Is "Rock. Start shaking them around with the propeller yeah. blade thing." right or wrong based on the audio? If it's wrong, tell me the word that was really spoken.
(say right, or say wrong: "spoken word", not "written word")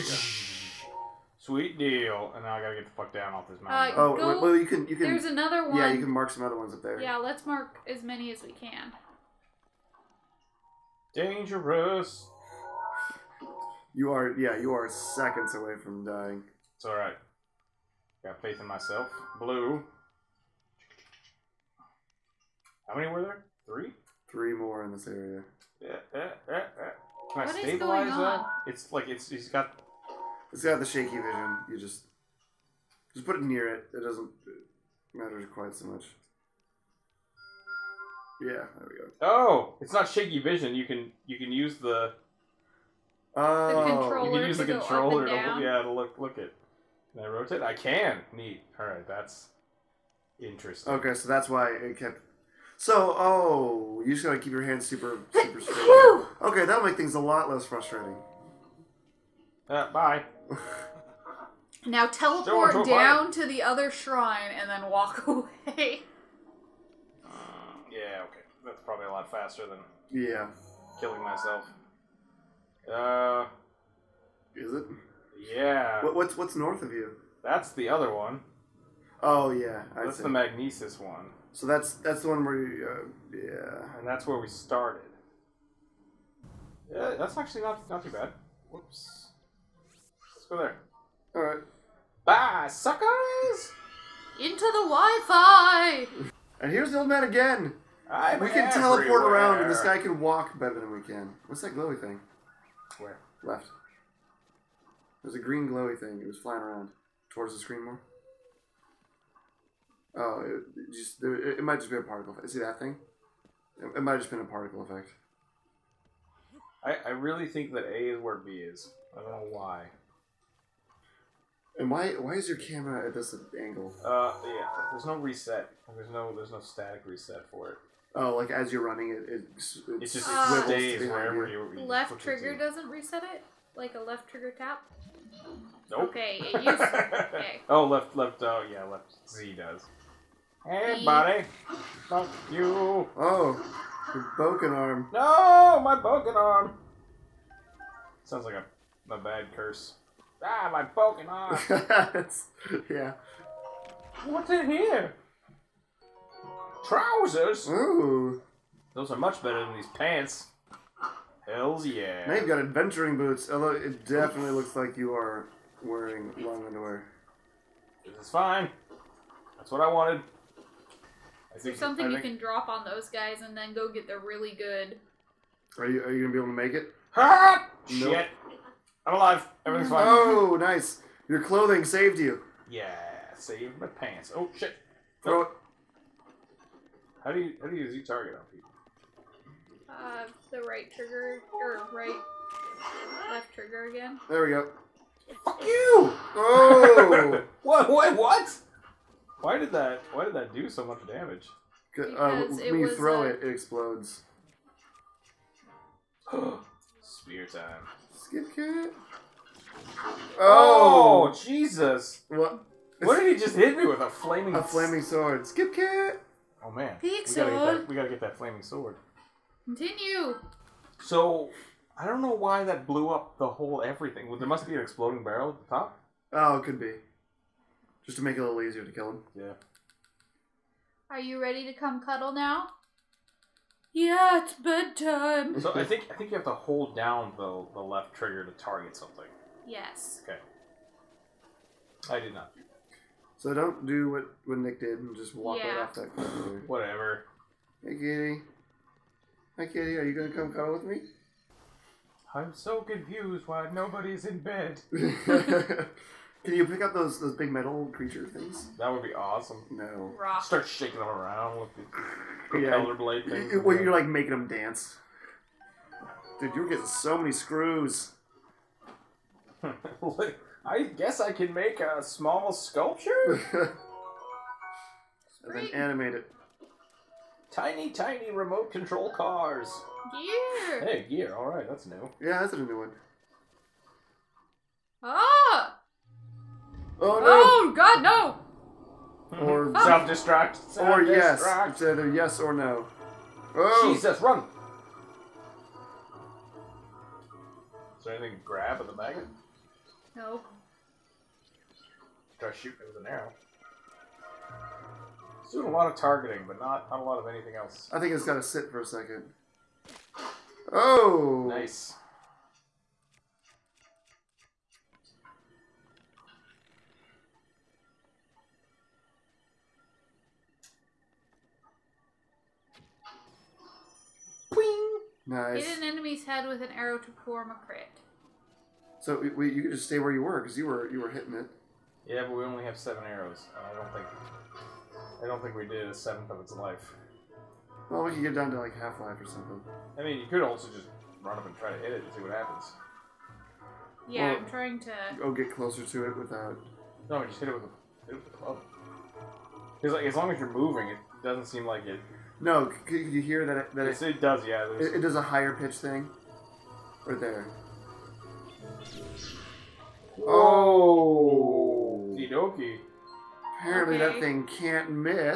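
right.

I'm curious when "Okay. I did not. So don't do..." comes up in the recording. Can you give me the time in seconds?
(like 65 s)
240 s.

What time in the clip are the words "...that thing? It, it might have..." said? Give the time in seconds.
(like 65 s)
112 s.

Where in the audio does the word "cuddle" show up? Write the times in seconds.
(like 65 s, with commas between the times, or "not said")
232 s, 250 s.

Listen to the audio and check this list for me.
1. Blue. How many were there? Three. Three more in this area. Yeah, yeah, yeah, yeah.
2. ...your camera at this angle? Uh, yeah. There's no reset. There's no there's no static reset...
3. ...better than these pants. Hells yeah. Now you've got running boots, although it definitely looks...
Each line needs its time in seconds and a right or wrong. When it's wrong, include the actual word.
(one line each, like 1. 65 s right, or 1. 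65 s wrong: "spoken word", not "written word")
1. 19 s right
2. 122 s right
3. 159 s wrong: "adventuring", not "running".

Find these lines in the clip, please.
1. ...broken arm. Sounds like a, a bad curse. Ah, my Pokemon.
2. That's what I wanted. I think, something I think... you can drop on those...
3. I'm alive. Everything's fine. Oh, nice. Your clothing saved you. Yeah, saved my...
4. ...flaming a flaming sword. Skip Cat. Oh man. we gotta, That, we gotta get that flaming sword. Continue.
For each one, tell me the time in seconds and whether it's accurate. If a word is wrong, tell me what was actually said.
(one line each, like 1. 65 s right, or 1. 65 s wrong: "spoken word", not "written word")
1. 145 s right
2. 169 s right
3. 179 s right
4. 214 s right.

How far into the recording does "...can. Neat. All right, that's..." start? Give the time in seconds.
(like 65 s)
47 s.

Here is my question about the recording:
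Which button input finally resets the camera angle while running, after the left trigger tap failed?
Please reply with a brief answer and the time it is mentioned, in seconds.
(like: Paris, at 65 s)
left Z, at 138 s.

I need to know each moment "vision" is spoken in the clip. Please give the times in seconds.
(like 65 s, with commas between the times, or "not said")
31 s, 40 s.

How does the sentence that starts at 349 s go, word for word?
Because like as long as you're moving, it doesn't seem like it no, could, could you hear that?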